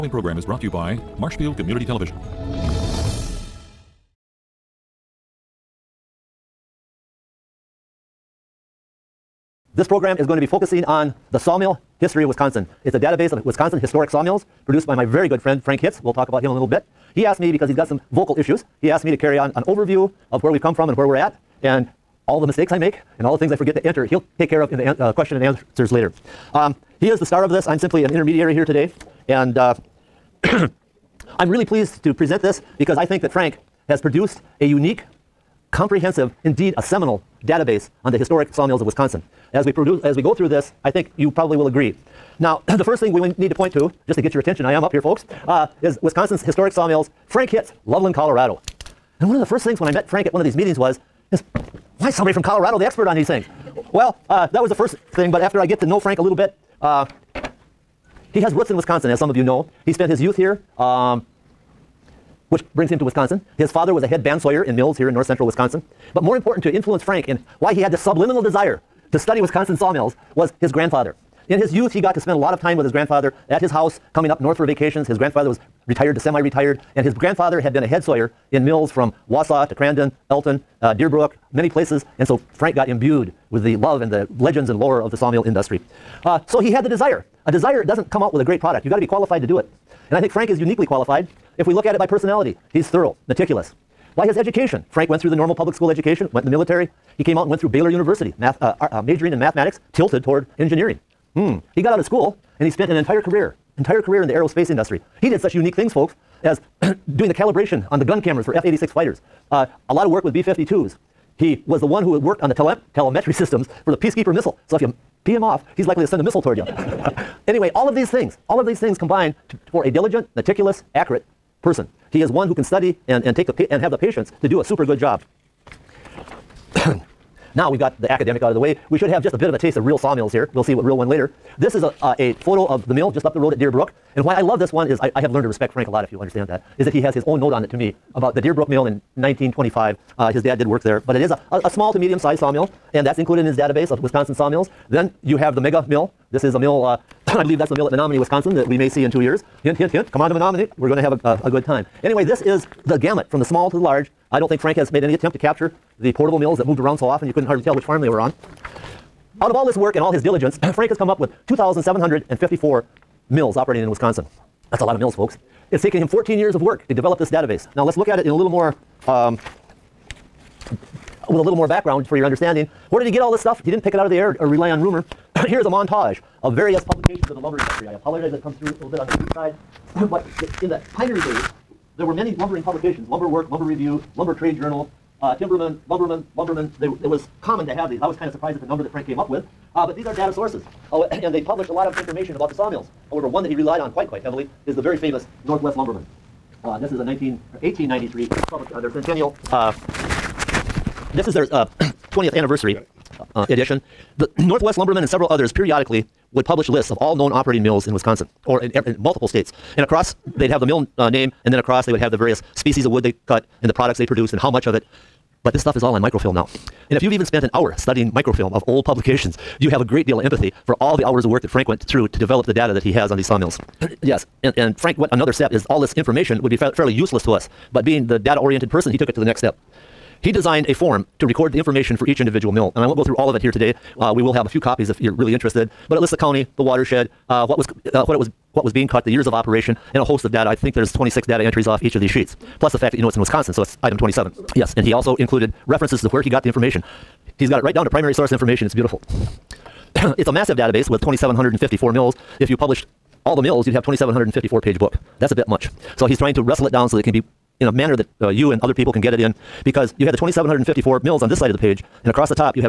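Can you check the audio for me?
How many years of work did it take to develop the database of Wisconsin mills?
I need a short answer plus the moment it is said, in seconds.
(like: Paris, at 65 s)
14, at 166 s.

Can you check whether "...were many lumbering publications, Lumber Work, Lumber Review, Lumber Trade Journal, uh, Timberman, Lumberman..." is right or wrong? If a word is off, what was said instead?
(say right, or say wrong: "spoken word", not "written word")
right.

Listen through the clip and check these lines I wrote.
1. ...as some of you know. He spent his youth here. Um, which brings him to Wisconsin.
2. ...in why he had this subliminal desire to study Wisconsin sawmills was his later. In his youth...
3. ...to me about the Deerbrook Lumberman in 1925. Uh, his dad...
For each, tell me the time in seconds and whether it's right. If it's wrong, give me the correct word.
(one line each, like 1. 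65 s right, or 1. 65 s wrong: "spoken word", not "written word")
1. 59 s right
2. 67 s wrong: "grandfather", not "later"
3. 137 s wrong: "Mill", not "Lumberman".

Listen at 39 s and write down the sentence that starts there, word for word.
As we, produce, as we go through this, I think you probably will agree.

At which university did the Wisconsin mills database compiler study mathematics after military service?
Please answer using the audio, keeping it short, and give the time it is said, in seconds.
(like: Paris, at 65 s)
Baylor University, at 97 s.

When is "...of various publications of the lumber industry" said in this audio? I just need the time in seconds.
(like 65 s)
176 s.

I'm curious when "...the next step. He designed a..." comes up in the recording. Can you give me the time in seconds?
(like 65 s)
229 s.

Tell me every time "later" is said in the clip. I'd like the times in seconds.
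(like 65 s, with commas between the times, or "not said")
25 s, 131 s.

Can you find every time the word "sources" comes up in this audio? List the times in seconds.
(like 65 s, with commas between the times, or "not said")
190 s, 248 s.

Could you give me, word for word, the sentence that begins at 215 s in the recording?
But this stuff is all on microfilm now.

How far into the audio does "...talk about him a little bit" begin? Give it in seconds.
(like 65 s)
16 s.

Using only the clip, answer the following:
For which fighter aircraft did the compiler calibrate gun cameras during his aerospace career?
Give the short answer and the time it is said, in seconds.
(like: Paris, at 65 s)
F-86, at 108 s.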